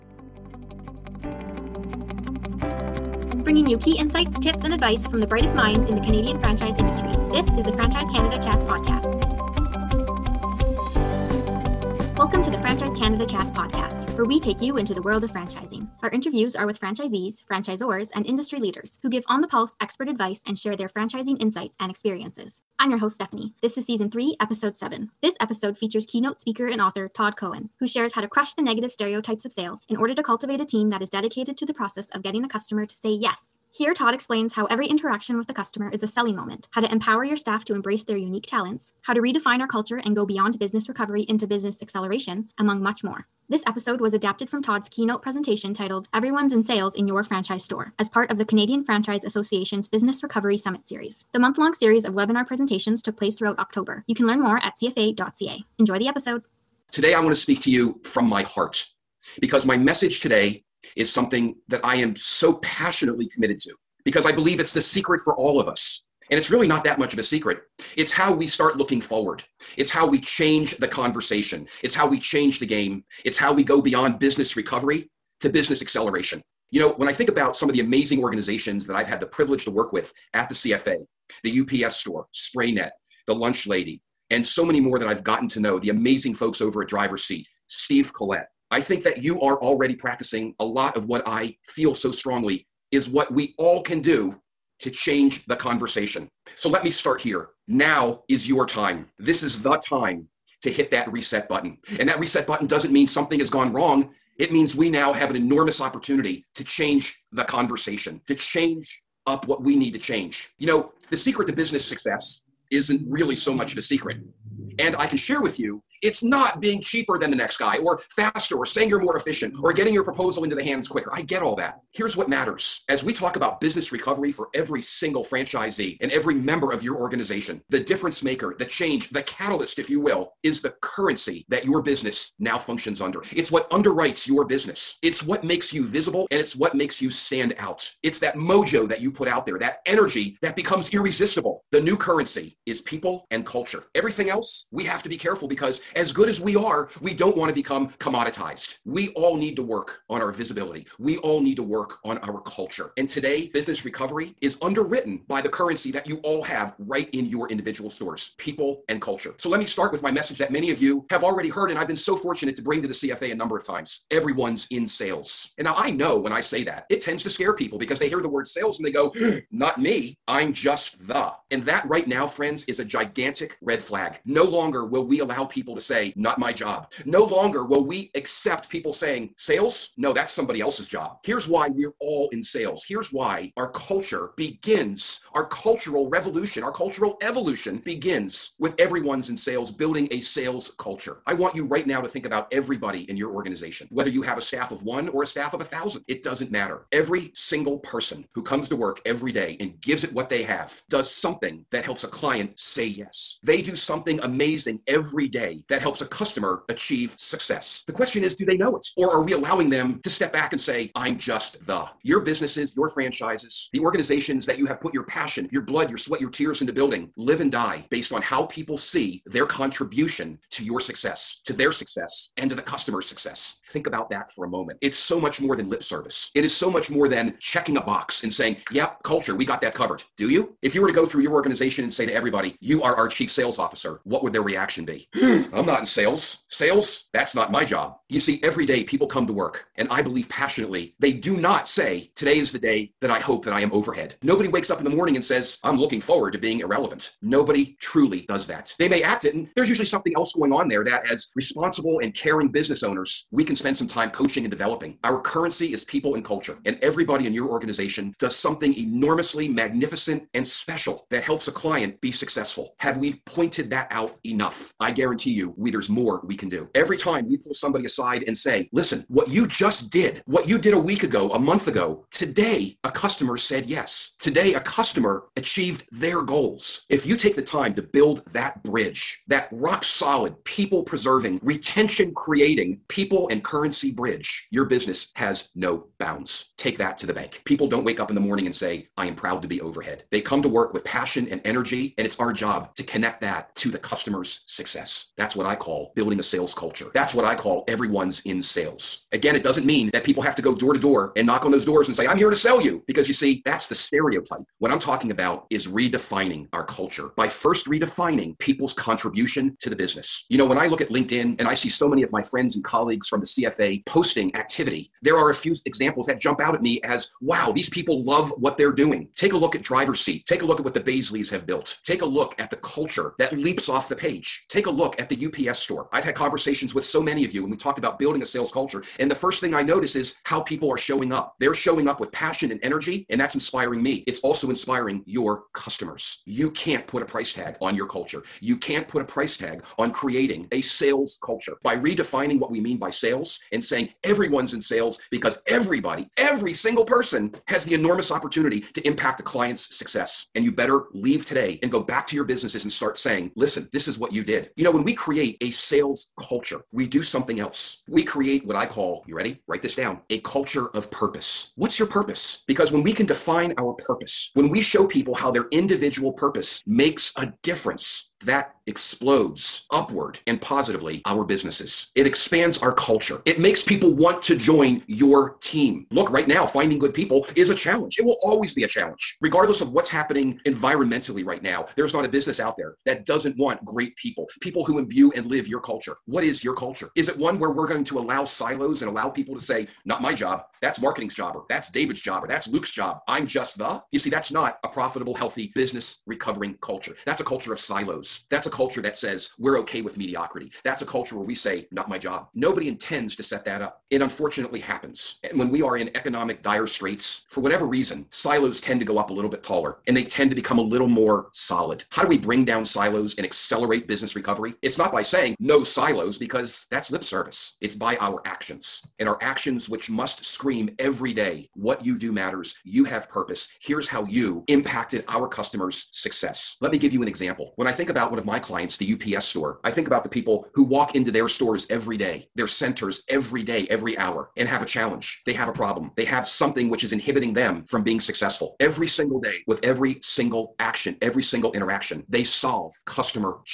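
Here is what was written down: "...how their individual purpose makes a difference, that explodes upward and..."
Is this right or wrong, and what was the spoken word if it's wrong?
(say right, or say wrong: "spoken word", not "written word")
right.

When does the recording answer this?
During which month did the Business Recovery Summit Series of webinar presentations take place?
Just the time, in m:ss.
0:53.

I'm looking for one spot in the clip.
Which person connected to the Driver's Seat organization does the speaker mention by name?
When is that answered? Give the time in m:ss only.
1:27.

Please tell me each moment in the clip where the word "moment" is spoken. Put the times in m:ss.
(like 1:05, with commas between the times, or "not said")
0:36, 3:44.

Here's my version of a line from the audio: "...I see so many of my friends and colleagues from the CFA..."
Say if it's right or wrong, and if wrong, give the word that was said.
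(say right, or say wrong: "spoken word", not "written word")
right.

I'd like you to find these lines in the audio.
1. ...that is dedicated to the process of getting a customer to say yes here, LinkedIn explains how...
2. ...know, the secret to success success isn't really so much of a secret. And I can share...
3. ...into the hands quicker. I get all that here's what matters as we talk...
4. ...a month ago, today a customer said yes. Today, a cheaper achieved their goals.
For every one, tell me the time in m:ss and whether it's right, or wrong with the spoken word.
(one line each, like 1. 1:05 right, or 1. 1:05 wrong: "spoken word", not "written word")
1. 0:30 wrong: "Todd", not "LinkedIn"
2. 1:50 wrong: "business", not "success"
3. 2:00 right
4. 4:31 wrong: "customer", not "cheaper".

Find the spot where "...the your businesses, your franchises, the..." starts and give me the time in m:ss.
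3:31.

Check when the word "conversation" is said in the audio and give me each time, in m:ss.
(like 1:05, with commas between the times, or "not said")
1:10, 1:35, 1:47, 5:26.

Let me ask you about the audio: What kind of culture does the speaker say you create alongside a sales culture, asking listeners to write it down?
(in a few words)
A culture of purpose.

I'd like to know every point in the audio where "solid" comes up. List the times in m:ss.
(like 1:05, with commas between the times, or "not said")
4:39, 6:51.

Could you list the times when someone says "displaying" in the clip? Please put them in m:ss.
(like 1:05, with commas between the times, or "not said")
not said.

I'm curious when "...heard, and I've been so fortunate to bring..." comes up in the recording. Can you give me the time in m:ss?
2:41.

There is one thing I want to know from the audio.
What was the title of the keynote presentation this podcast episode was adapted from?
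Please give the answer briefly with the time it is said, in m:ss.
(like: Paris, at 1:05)
Everyone's in Sales in Your Franchise Store, at 0:46.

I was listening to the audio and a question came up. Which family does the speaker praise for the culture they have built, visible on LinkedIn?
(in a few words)
The Baisleys.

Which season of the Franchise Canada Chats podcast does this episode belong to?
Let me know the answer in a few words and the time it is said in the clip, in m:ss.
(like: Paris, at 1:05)
3, at 0:23.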